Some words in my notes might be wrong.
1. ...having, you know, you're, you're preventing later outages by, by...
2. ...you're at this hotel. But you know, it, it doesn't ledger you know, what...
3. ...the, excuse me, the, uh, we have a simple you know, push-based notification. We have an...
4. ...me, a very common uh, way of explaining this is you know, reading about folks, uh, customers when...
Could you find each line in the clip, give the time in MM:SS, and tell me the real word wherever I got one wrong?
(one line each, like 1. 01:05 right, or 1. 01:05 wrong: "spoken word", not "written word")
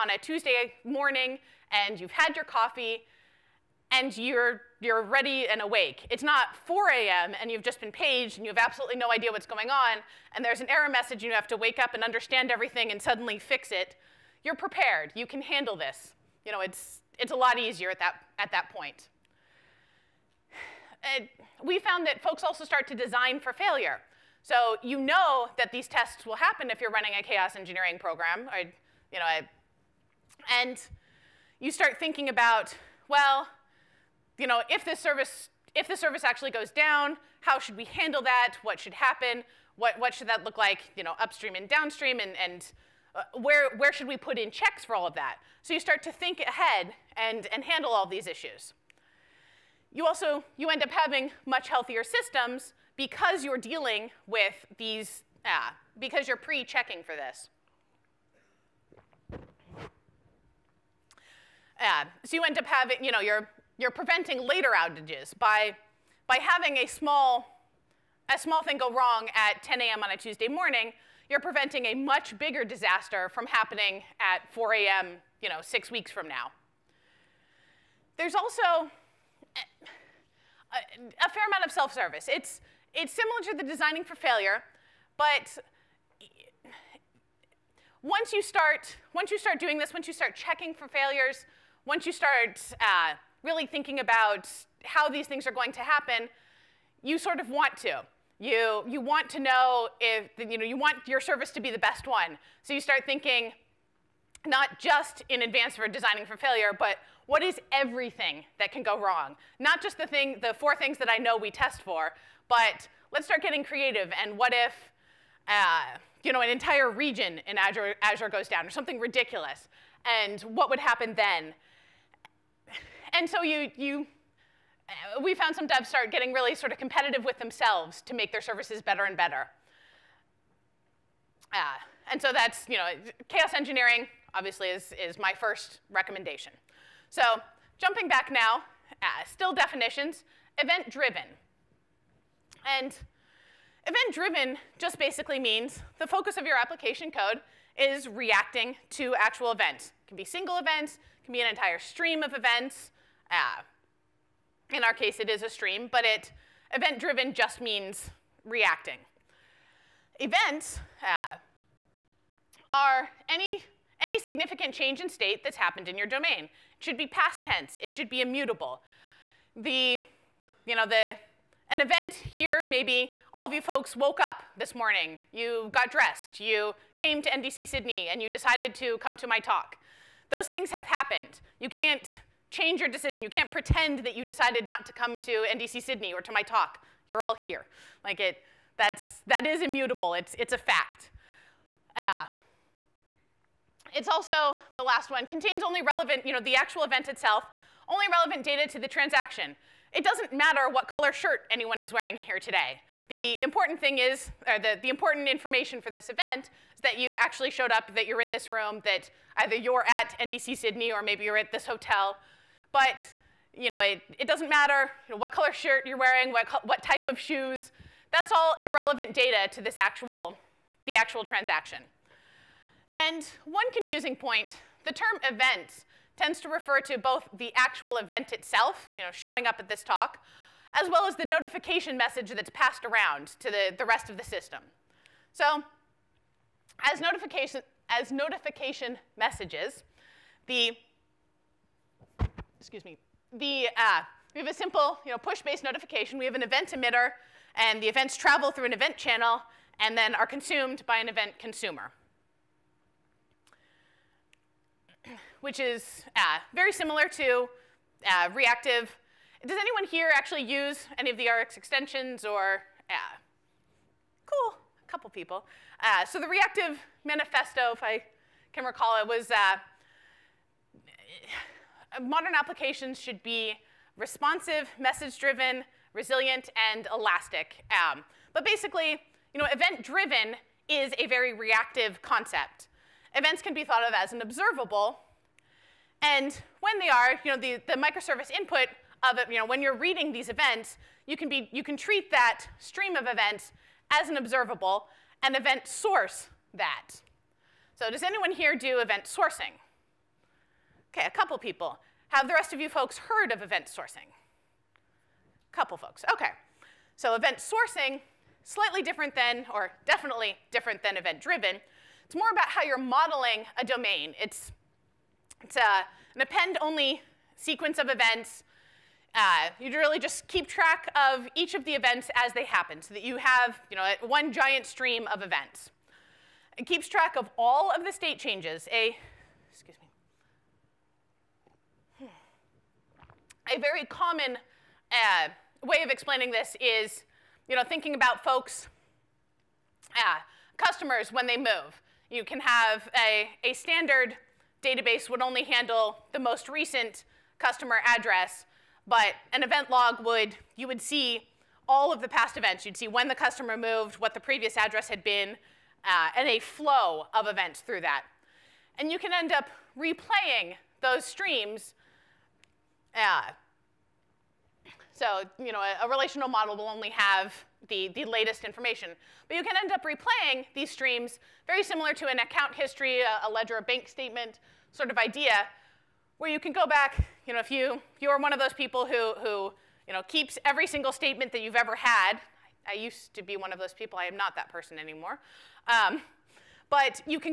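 1. 01:02 right
2. 03:31 wrong: "matter", not "ledger"
3. 04:00 right
4. 05:32 wrong: "thinking", not "reading".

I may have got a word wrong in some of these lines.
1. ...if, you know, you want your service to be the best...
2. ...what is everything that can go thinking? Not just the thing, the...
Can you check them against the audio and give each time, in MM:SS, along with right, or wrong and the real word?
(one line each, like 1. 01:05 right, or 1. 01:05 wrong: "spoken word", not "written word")
1. 01:40 right
2. 01:47 wrong: "wrong", not "thinking".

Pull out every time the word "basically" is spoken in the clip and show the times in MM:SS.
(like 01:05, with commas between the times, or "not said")
02:24, 04:38.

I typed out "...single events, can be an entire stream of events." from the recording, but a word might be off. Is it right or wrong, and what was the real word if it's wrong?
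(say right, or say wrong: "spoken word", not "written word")
right.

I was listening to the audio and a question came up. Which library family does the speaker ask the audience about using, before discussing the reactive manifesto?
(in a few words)
Rx extensions.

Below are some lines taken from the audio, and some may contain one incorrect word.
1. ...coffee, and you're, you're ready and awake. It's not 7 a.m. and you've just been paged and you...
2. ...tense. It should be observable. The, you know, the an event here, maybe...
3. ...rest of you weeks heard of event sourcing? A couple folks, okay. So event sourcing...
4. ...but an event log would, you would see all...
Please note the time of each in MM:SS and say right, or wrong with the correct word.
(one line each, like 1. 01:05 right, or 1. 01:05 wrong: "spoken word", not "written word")
1. 00:02 wrong: "4", not "7"
2. 02:47 wrong: "immutable", not "observable"
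3. 05:02 wrong: "folks", not "weeks"
4. 05:48 right.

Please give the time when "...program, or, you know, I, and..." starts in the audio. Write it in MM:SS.
00:27.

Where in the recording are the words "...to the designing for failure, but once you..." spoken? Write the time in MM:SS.
01:23.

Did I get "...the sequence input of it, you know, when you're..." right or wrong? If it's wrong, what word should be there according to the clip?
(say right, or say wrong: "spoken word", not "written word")
wrong: "microservice", not "sequence".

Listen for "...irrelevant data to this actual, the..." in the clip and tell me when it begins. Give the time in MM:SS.
03:38.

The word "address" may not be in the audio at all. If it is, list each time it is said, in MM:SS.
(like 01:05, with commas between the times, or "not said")
05:47, 05:54.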